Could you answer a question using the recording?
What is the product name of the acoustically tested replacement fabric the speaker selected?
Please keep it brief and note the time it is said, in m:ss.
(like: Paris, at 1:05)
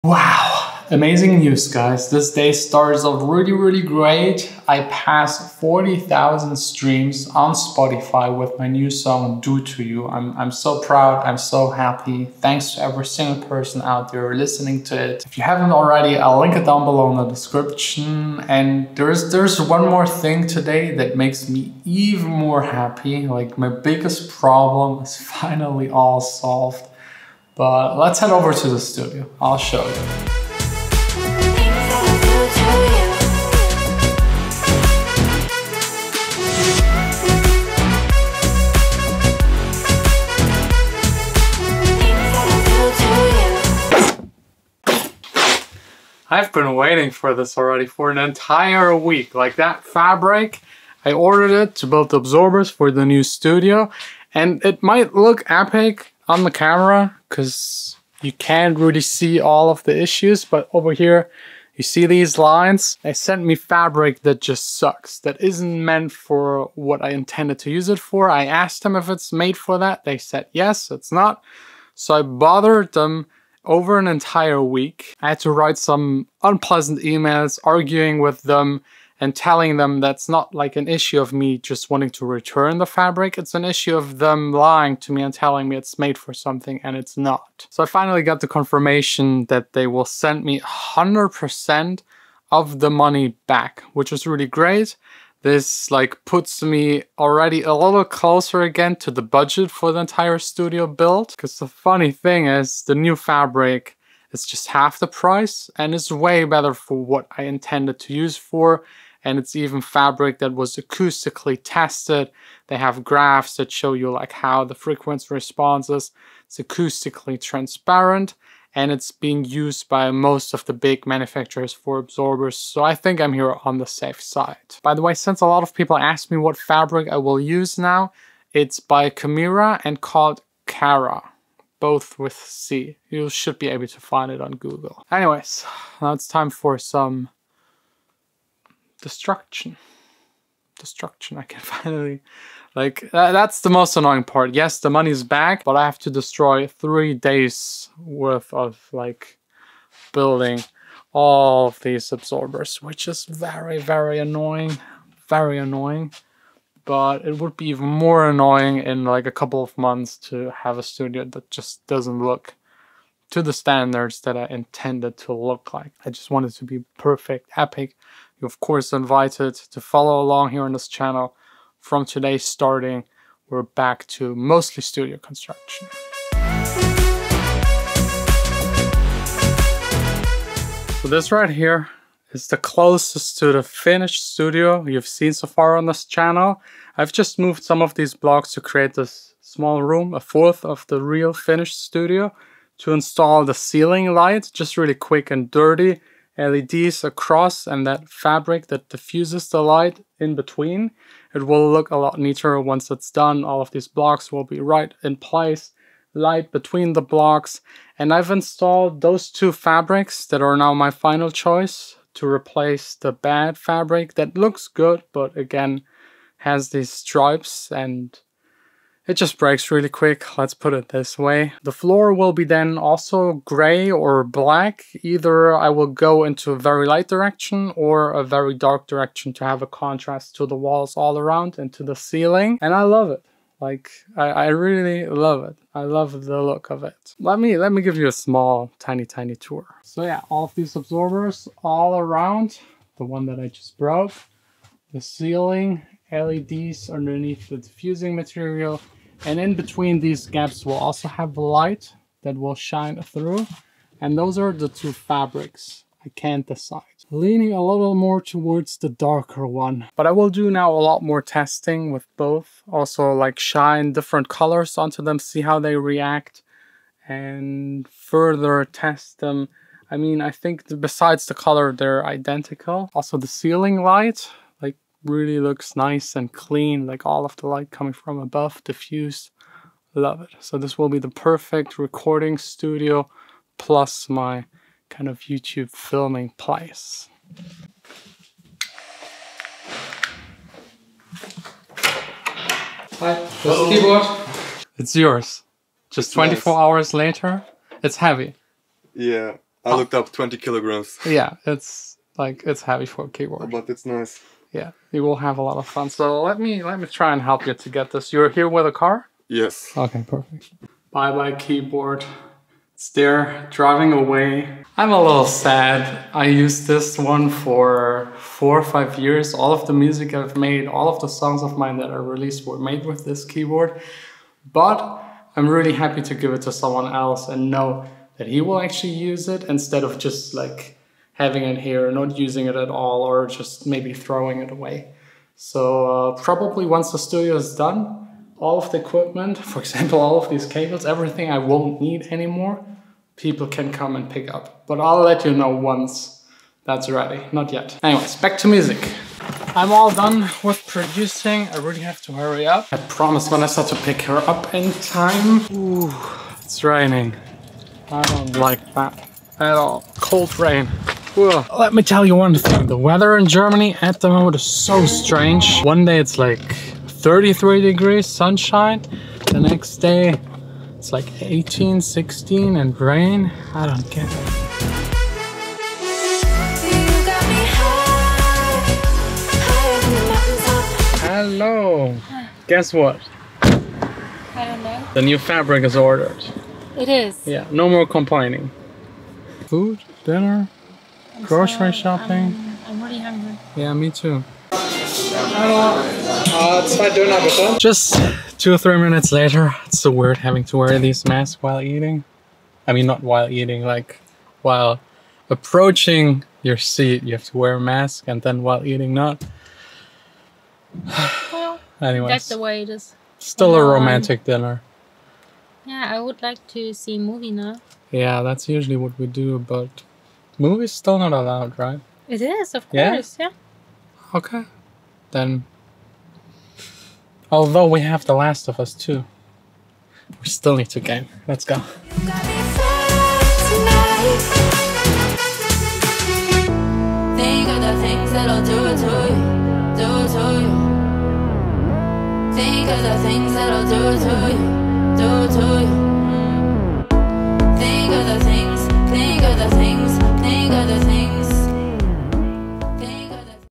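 Cara, at 2:10.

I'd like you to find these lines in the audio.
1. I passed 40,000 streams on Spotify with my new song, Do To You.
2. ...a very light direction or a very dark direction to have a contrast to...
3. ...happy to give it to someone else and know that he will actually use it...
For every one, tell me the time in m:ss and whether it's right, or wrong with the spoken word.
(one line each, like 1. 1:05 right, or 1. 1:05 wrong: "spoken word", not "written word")
1. 0:04 right
2. 3:46 right
3. 5:25 right.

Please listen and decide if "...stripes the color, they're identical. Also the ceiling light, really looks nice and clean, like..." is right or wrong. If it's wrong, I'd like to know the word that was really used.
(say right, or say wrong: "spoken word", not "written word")
wrong: "besides", not "stripes".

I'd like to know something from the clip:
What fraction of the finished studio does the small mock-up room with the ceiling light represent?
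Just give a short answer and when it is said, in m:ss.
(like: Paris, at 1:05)
A fourth, at 3:10.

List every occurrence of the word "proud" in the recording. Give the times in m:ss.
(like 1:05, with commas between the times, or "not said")
0:10.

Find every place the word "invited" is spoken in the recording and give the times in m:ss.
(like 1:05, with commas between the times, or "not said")
2:48.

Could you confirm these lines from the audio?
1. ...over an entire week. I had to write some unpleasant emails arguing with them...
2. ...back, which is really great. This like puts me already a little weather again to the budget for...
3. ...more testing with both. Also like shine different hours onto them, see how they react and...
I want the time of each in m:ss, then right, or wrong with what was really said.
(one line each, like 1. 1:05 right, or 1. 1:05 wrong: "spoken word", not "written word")
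1. 1:13 right
2. 1:33 wrong: "closer", not "weather"
3. 4:21 wrong: "colors", not "hours".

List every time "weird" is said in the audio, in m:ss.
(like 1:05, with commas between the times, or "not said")
6:39.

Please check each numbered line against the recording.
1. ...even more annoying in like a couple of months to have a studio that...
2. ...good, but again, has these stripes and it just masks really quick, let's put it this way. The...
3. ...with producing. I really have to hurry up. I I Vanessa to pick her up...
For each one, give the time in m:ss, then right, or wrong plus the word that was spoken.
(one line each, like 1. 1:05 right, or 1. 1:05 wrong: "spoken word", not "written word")
1. 2:37 right
2. 3:34 wrong: "breaks", not "masks"
3. 5:50 right.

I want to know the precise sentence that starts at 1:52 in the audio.
They have graphs that show you like how the frequency responses.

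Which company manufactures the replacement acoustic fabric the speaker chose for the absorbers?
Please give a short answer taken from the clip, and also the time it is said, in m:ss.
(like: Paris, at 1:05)
Camira, at 2:09.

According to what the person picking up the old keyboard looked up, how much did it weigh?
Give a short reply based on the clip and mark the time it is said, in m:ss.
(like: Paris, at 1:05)
20 kilograms, at 5:00.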